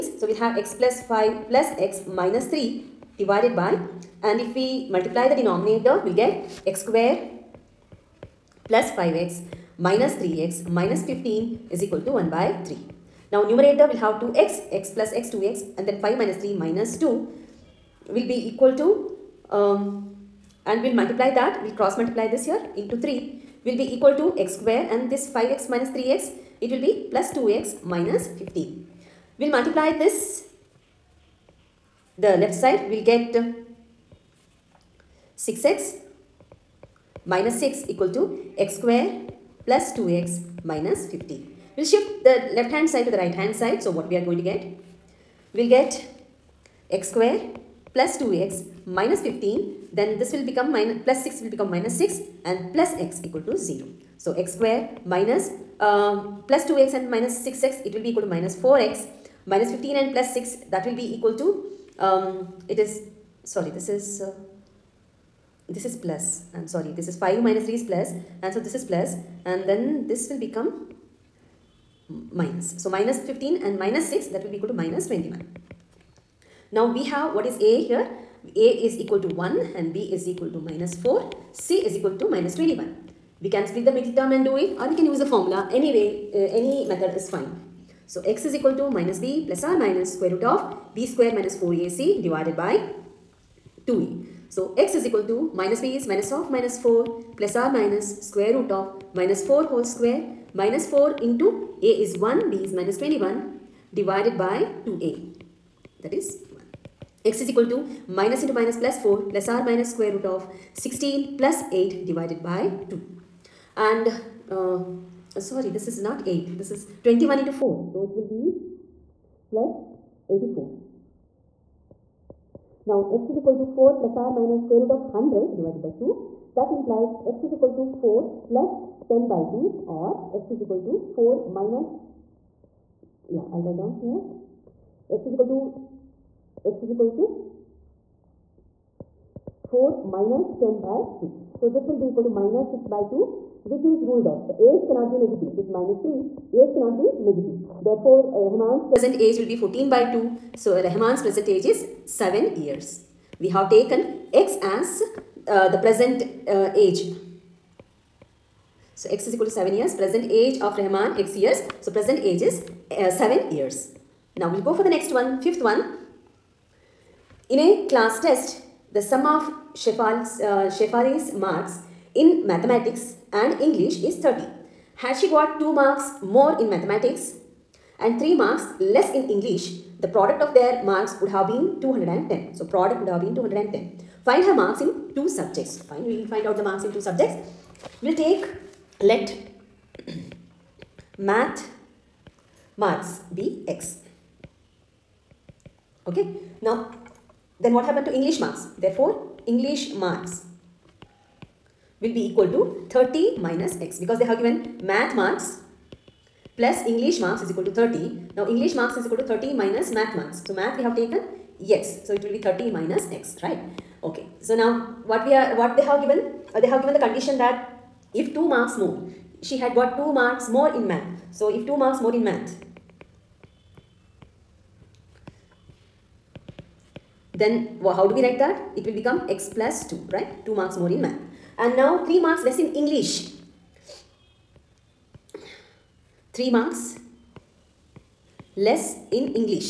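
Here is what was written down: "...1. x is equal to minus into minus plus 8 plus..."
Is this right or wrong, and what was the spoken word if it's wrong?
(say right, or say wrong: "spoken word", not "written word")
wrong: "4", not "8".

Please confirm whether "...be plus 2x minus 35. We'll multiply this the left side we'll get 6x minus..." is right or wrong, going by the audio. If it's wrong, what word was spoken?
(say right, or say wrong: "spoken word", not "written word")
wrong: "15", not "35".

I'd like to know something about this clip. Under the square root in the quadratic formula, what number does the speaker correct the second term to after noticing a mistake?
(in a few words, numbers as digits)
84.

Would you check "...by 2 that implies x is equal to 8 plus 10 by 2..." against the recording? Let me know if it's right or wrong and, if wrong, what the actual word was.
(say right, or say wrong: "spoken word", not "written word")
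wrong: "4", not "8".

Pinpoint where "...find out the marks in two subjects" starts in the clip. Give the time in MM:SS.
03:06.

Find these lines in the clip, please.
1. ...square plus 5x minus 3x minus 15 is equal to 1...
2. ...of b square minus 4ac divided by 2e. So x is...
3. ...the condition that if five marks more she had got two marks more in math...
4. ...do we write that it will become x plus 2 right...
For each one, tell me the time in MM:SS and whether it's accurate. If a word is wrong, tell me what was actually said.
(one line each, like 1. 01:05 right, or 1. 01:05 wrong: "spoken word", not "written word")
1. 00:06 right
2. 01:30 right
3. 03:36 wrong: "two", not "five"
4. 03:48 right.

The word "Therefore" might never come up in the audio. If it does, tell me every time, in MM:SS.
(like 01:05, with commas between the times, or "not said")
02:27, 03:18.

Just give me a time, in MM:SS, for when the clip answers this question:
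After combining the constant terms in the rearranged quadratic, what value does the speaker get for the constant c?
01:21.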